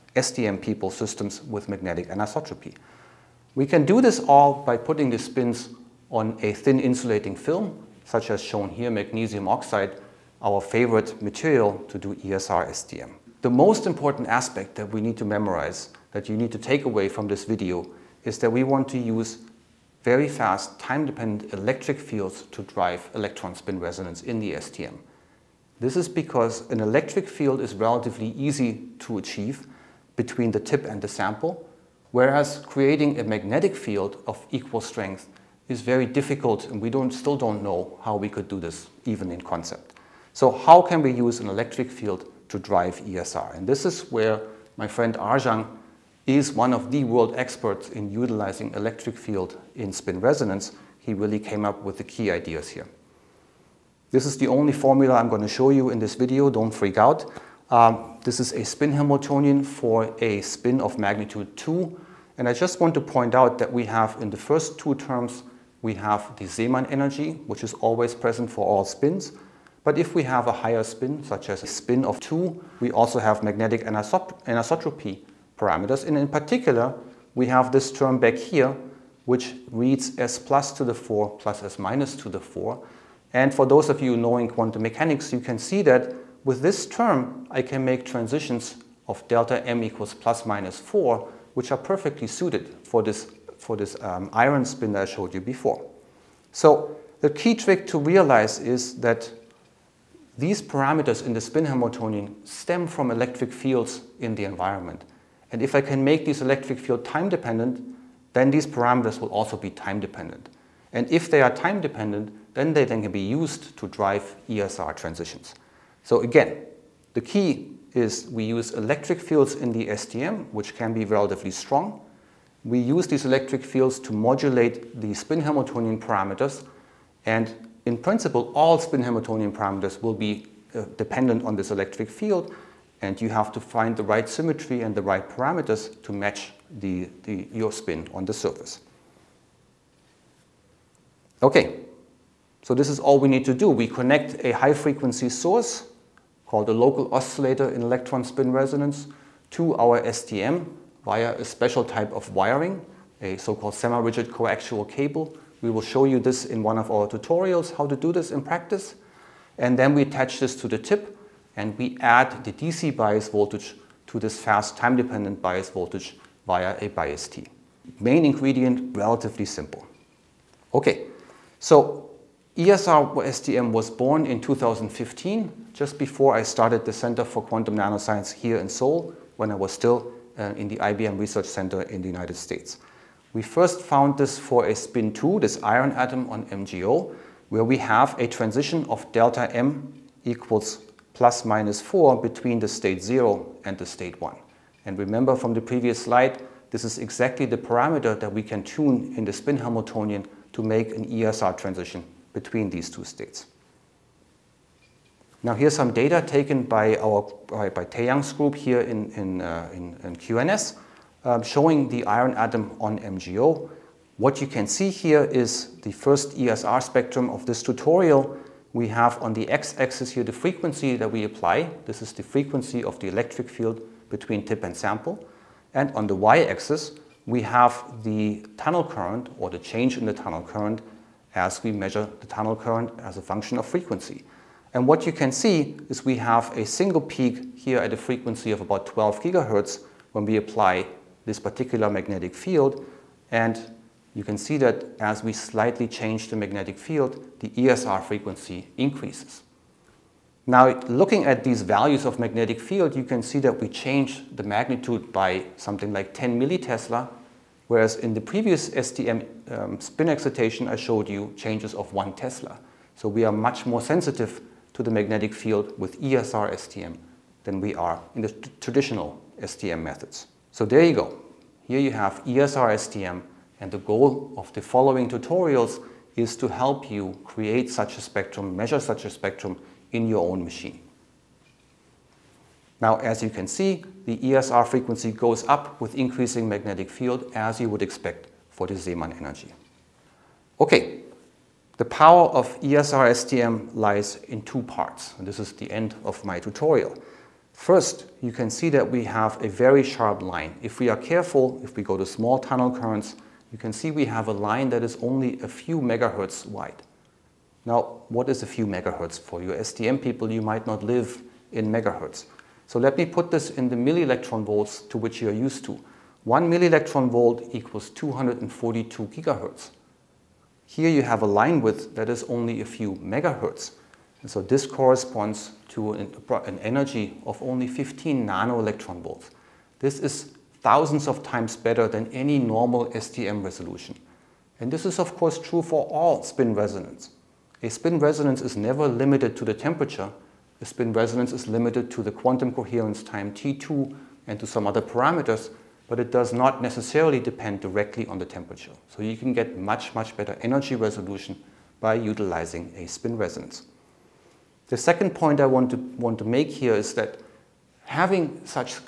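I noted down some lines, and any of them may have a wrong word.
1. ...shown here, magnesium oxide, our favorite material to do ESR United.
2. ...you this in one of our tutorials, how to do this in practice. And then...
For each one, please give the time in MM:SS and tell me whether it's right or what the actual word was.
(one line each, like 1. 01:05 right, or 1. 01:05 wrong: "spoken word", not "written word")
1. 00:08 wrong: "STM", not "United"
2. 02:36 right.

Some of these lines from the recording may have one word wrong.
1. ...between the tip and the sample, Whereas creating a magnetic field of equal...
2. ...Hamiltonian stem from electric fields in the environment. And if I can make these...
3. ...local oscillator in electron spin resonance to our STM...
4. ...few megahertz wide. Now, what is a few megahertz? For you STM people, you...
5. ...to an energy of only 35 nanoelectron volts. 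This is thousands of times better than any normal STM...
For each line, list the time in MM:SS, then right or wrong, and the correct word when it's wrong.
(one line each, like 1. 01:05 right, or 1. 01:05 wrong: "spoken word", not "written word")
1. 00:30 right
2. 01:41 right
3. 02:26 right
4. 05:05 right
5. 05:25 wrong: "15", not "35".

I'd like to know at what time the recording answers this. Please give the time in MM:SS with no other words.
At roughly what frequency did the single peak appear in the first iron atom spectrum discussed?
03:58.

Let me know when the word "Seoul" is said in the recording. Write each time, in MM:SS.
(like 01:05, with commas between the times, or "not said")
02:58.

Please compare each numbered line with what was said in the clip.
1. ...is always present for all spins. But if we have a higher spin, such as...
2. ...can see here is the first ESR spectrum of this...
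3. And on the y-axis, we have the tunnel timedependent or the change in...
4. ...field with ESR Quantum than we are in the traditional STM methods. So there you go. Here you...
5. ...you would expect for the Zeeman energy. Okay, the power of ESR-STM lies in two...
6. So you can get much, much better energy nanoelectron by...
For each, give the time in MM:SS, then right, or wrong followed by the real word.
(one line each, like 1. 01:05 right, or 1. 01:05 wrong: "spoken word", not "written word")
1. 01:07 right
2. 03:34 right
3. 03:45 wrong: "current", not "timedependent"
4. 04:25 wrong: "STM", not "Quantum"
5. 04:47 right
6. 05:48 wrong: "resolution", not "nanoelectron".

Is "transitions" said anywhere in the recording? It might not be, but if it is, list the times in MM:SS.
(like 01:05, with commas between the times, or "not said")
01:28, 01:54, 03:08, 03:21.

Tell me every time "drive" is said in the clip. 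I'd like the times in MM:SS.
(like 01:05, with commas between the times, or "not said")
00:22, 00:42, 01:53.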